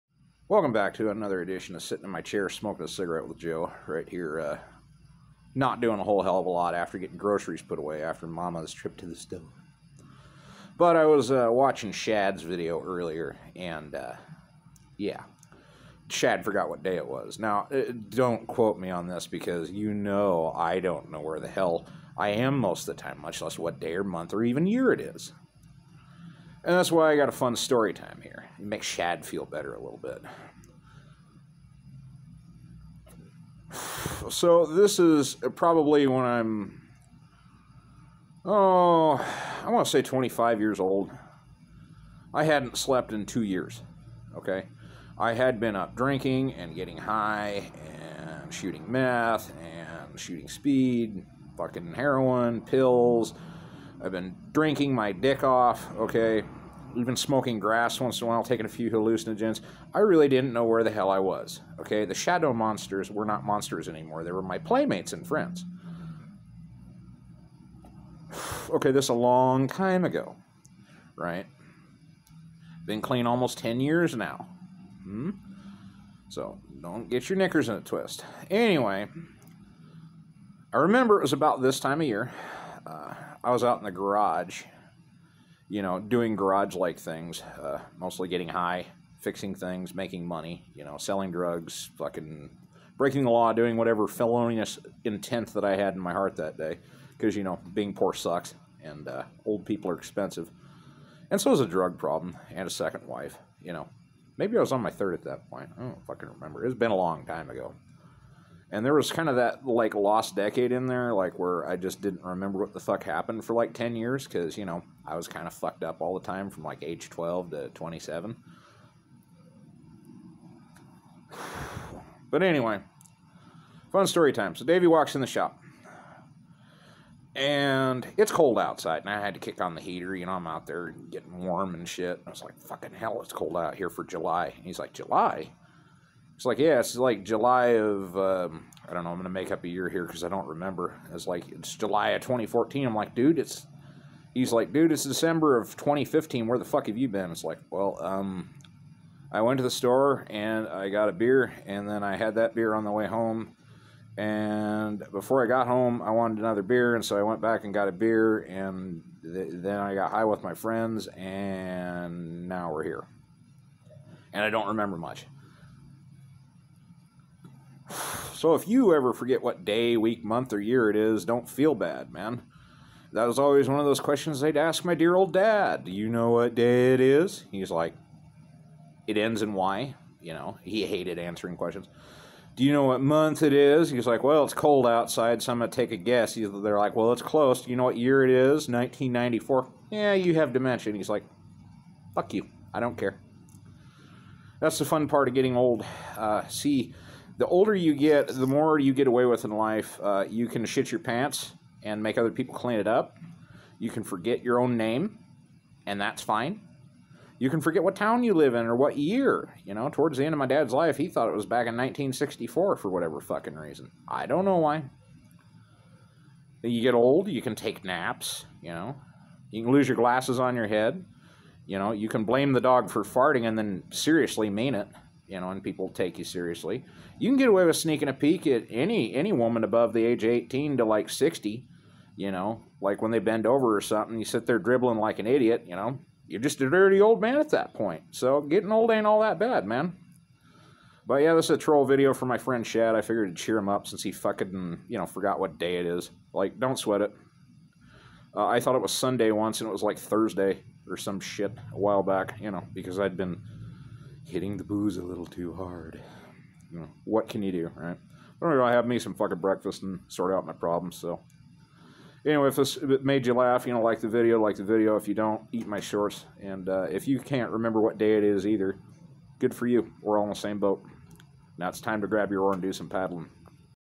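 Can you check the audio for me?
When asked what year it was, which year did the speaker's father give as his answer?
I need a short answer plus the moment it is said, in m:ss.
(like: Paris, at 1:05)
1994, at 3:08.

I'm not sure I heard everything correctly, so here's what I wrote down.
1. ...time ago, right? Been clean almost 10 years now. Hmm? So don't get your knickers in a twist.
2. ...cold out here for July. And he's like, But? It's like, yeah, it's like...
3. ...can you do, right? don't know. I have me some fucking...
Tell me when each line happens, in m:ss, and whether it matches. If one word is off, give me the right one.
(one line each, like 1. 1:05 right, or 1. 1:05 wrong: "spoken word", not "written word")
1. 1:09 right
2. 2:13 wrong: "July", not "But"
3. 4:17 right.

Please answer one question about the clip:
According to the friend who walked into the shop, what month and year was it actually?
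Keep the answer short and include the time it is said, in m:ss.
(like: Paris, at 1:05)
December of 2015, at 2:25.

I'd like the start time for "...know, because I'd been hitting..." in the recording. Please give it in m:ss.
4:12.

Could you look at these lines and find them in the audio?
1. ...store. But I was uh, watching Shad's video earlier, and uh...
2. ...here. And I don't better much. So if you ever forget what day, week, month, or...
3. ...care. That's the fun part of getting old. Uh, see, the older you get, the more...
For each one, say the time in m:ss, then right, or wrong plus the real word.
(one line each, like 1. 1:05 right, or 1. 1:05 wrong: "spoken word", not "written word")
1. 0:09 right
2. 2:42 wrong: "remember", not "better"
3. 3:12 right.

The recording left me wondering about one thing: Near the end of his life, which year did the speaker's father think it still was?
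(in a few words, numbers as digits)
1964.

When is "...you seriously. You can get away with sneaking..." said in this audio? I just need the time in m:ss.
3:46.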